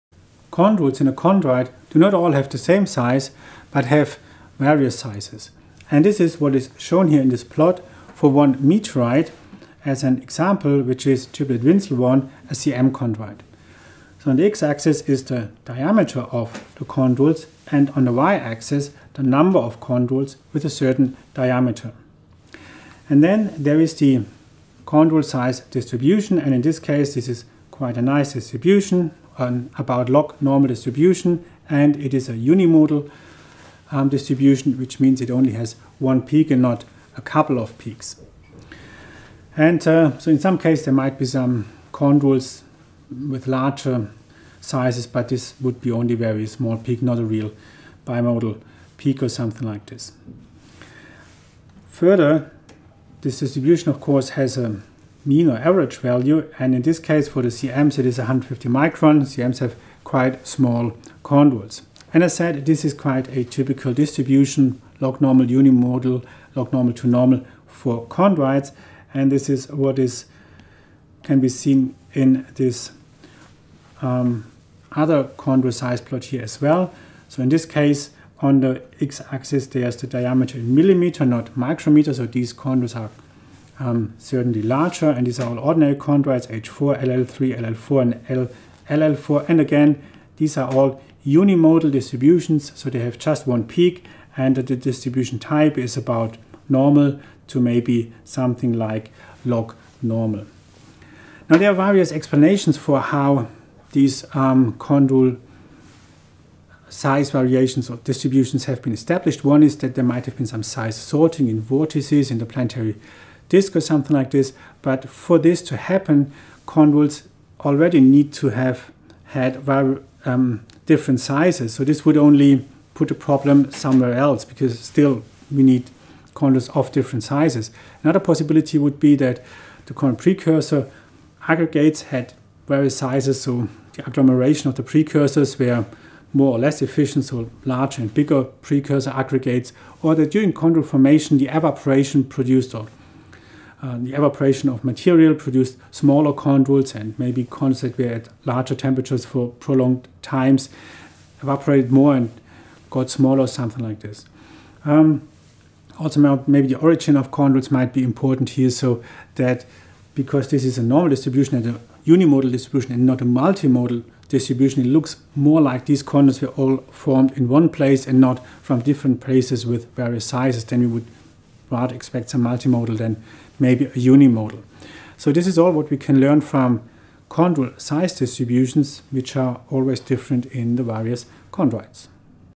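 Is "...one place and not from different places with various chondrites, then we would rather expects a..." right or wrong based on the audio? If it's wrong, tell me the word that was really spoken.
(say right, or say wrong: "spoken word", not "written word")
wrong: "sizes", not "chondrites".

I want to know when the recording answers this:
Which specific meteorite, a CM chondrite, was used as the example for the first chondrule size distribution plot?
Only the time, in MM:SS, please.
00:11.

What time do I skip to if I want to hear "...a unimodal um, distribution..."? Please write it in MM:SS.
00:32.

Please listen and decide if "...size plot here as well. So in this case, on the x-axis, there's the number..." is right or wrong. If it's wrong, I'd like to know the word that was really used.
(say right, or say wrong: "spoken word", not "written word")
wrong: "diameter", not "number".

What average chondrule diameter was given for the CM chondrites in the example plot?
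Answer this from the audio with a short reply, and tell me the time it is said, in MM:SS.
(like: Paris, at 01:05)
150 microns, at 00:58.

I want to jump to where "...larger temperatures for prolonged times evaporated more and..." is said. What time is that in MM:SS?
02:28.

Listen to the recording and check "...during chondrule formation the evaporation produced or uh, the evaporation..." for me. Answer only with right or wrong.
right.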